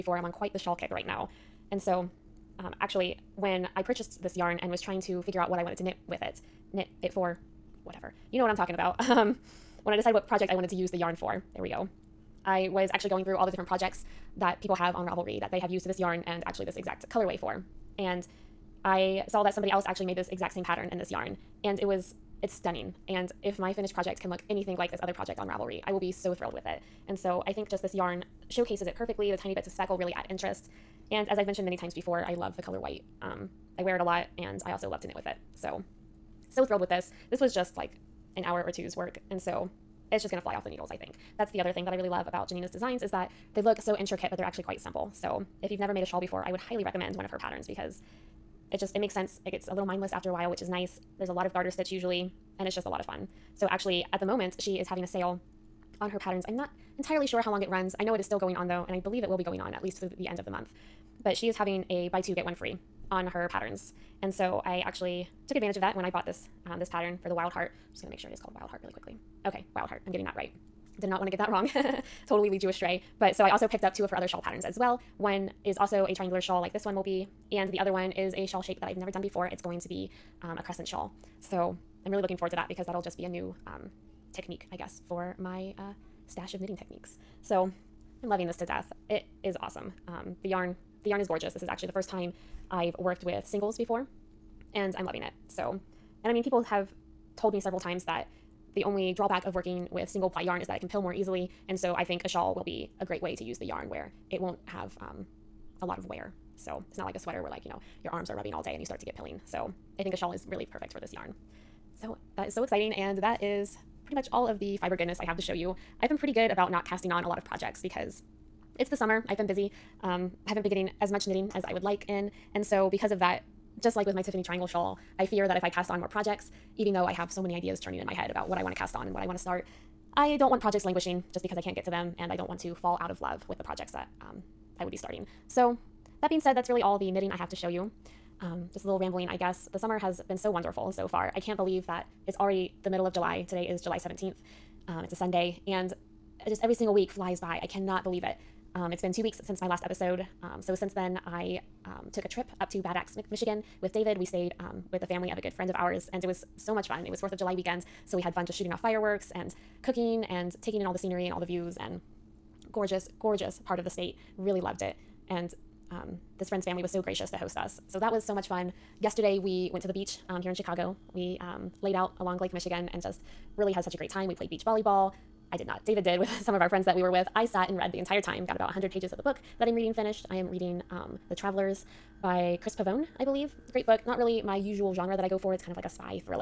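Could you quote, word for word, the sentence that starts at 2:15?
So, that being said, that's really all the knitting I have to show you.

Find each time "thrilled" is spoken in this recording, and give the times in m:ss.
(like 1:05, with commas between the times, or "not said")
0:26, 0:36.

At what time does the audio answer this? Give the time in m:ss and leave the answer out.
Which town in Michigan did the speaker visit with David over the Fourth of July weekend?
2:32.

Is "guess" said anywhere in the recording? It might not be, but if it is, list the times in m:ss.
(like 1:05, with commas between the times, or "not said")
1:24, 2:19.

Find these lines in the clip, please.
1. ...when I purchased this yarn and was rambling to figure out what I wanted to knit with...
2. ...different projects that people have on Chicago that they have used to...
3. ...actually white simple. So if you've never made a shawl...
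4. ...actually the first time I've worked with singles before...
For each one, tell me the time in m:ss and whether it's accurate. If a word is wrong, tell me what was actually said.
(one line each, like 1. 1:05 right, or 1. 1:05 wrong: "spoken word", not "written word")
1. 0:03 wrong: "trying", not "rambling"
2. 0:13 wrong: "Ravelry", not "Chicago"
3. 0:44 wrong: "quite", not "white"
4. 1:31 right.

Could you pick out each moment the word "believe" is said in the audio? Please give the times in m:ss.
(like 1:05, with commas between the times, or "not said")
0:58, 2:21, 2:28, 3:03.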